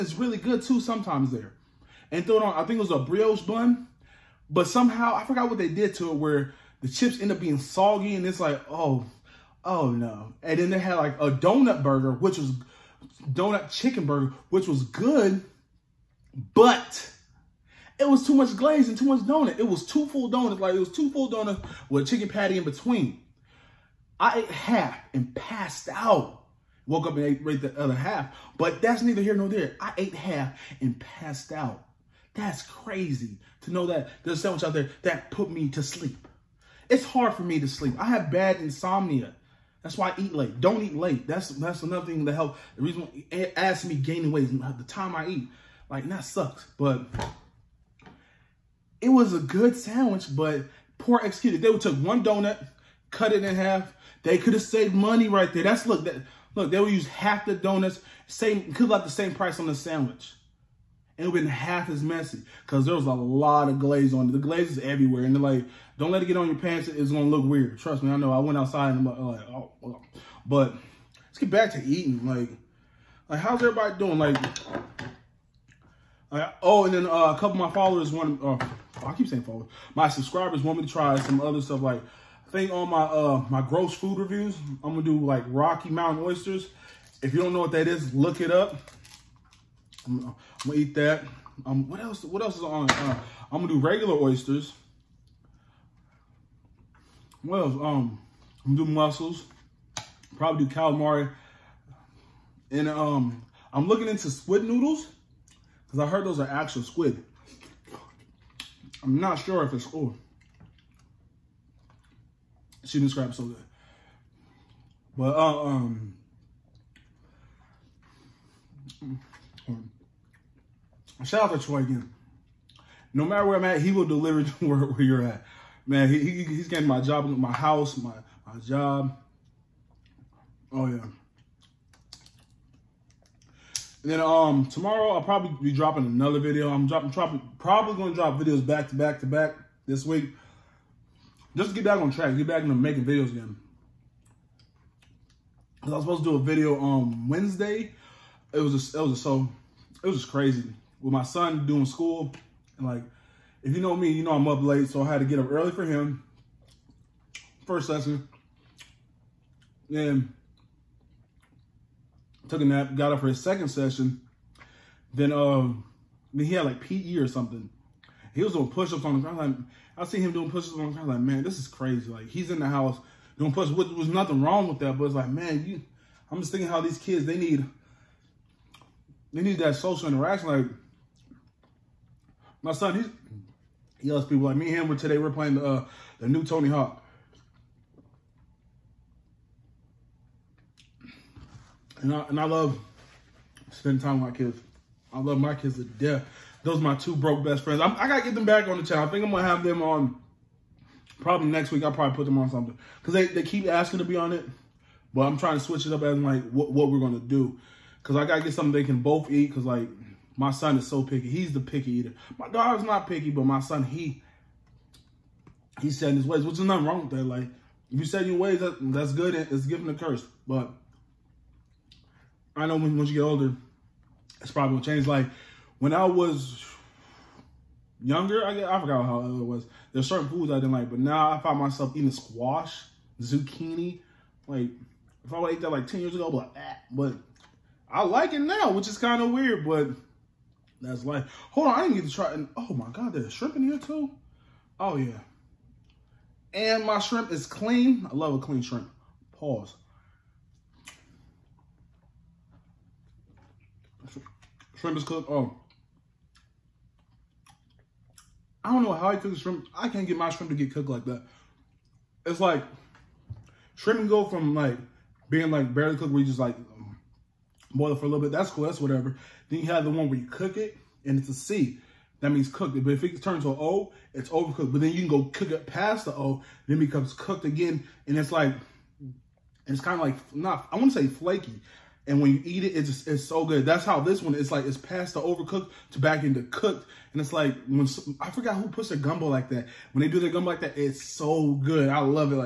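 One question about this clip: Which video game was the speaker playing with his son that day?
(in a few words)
Tony Hawk.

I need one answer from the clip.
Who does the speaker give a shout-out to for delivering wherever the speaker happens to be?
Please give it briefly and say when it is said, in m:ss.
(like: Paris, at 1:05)
Troy, at 2:01.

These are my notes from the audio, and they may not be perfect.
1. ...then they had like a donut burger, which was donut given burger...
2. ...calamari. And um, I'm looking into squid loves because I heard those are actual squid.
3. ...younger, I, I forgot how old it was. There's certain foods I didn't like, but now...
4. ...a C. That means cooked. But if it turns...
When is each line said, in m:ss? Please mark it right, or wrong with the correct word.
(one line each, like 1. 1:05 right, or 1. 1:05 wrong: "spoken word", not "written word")
1. 0:10 wrong: "chicken", not "given"
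2. 1:40 wrong: "noodles", not "loves"
3. 3:48 right
4. 4:31 right.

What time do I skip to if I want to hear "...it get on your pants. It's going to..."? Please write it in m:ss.
1:06.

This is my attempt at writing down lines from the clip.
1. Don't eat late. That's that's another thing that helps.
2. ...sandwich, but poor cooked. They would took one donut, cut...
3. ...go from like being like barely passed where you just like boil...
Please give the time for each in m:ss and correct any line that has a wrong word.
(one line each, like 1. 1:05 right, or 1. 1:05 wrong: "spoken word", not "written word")
1. 0:40 right
2. 0:49 wrong: "executed", not "cooked"
3. 4:24 wrong: "cooked", not "passed".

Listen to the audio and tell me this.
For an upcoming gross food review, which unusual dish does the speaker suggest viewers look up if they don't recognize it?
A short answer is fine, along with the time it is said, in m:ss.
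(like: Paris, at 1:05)
Rocky Mountain oysters, at 1:25.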